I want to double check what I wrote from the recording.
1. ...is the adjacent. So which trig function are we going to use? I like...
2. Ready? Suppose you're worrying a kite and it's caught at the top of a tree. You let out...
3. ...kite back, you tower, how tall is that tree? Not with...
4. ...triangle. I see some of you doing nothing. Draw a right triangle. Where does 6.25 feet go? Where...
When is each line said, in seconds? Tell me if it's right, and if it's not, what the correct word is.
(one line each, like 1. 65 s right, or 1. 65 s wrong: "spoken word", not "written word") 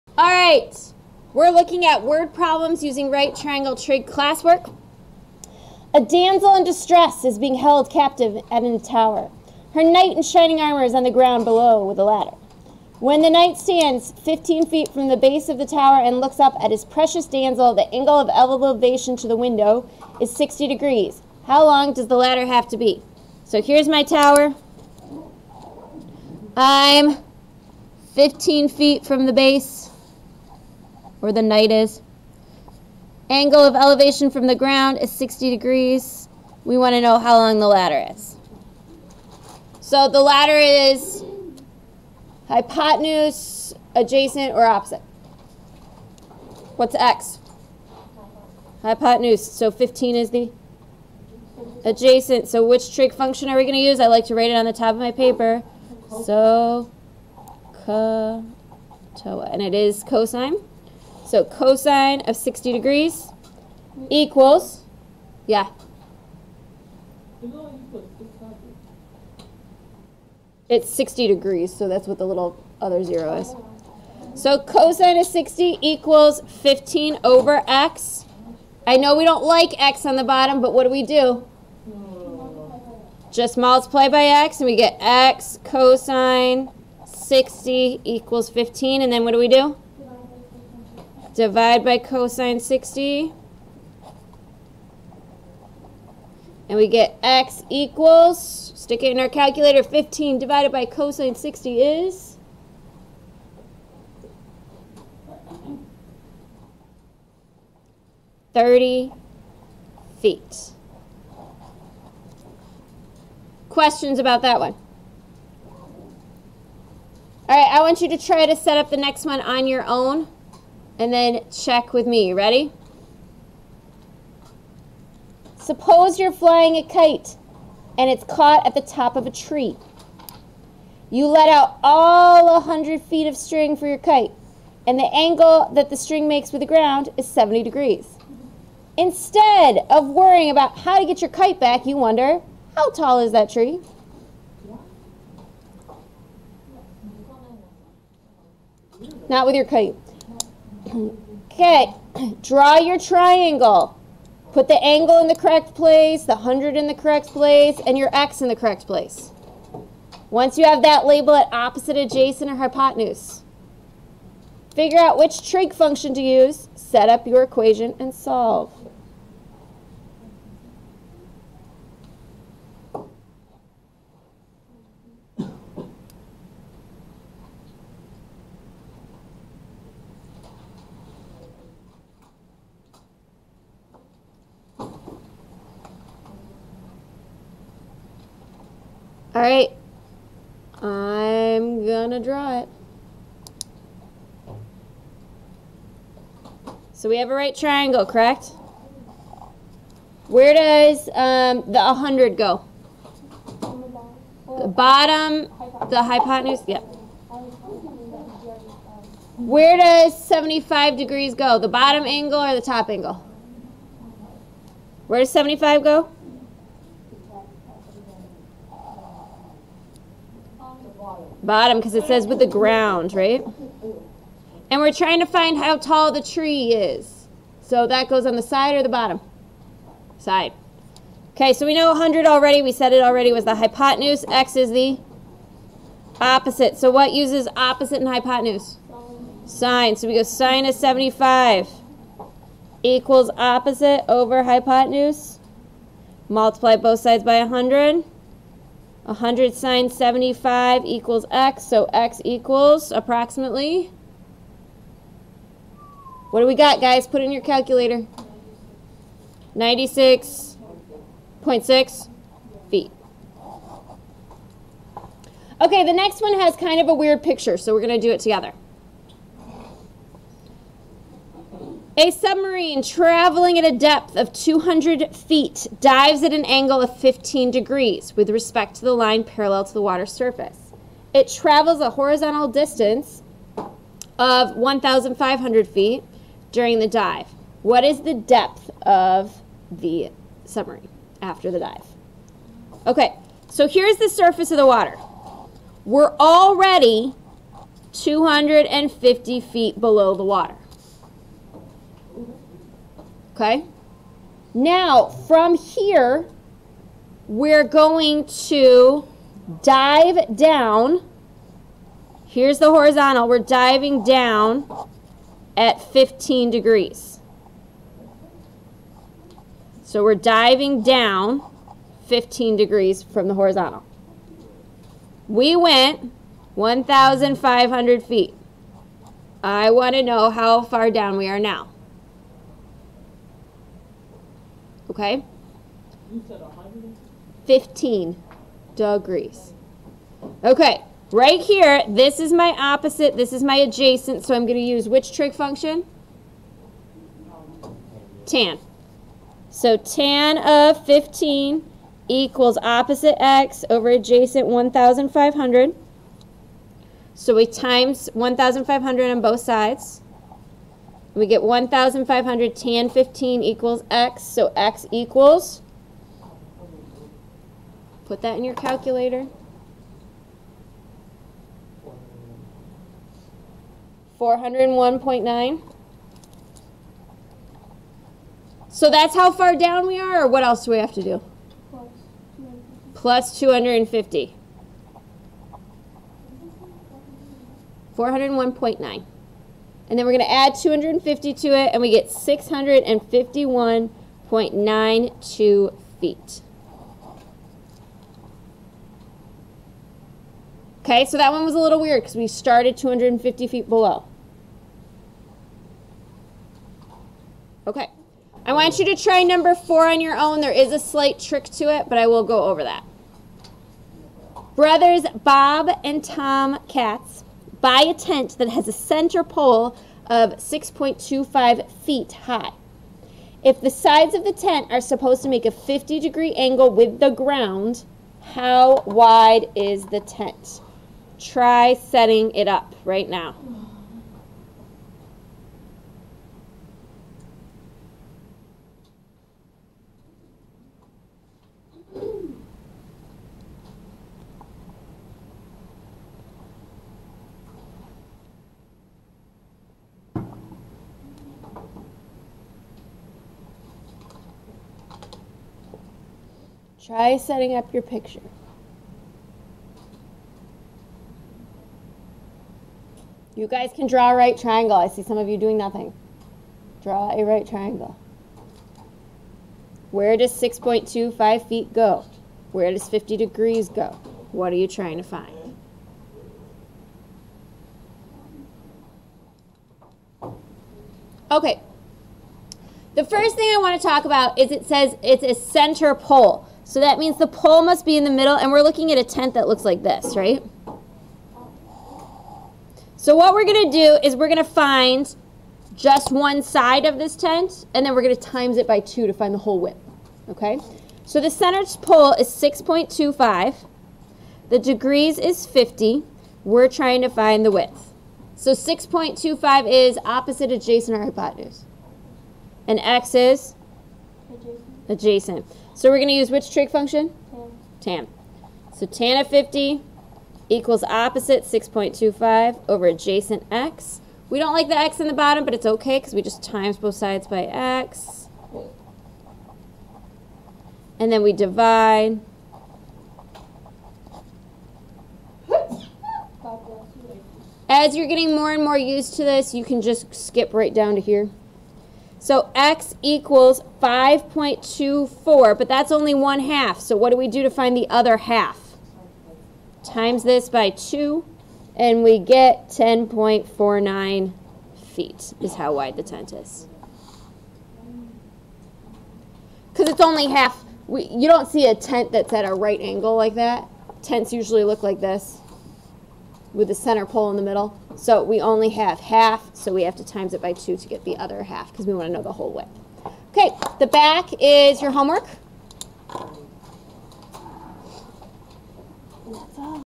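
1. 50 s right
2. 122 s wrong: "flying", not "worrying"
3. 141 s wrong: "wonder", not "tower"
4. 464 s right.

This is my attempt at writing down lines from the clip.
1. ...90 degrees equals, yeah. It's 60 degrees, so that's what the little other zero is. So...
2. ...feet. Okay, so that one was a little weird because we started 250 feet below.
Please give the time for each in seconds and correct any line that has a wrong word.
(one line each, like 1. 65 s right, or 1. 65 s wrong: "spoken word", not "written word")
1. 62 s wrong: "60", not "90"
2. 395 s right.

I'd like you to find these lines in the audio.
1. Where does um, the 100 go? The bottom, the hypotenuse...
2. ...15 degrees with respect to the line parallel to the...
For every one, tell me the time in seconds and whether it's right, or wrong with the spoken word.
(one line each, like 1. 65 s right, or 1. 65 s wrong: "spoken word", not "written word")
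1. 200 s right
2. 276 s right.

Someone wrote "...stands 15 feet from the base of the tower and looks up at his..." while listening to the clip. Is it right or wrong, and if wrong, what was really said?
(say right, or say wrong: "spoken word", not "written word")
right.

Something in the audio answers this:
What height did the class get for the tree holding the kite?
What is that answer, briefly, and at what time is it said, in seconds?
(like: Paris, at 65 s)
96.6 feet, at 259 s.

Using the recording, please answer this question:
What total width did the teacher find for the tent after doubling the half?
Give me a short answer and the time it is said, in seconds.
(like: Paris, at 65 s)
10.49 feet, at 552 s.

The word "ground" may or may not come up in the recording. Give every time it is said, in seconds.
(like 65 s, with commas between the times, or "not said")
11 s, 34 s, 136 s, 222 s, 427 s.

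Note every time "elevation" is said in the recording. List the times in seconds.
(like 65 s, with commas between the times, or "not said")
18 s, 33 s.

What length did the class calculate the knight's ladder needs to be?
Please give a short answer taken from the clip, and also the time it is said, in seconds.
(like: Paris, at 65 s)
30 feet, at 108 s.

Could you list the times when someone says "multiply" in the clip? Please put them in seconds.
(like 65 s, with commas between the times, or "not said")
83 s, 246 s.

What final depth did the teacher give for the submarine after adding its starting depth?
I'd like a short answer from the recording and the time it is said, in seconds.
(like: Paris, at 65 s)
651.92 feet, at 392 s.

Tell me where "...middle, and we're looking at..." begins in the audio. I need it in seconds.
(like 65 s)
488 s.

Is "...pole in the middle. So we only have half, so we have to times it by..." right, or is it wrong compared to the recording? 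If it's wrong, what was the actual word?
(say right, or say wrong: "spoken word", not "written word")
right.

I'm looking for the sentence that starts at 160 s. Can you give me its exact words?
Once you have that, label it opposite adjacent or hypotenuse.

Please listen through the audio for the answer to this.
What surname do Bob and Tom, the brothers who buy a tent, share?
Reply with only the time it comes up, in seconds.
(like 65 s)
416 s.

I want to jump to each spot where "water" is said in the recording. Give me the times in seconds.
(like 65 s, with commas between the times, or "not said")
279 s, 294 s, 300 s.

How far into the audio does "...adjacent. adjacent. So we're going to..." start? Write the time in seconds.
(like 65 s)
514 s.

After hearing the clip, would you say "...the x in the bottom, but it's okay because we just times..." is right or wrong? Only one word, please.
right.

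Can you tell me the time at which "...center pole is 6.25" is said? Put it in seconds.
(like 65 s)
501 s.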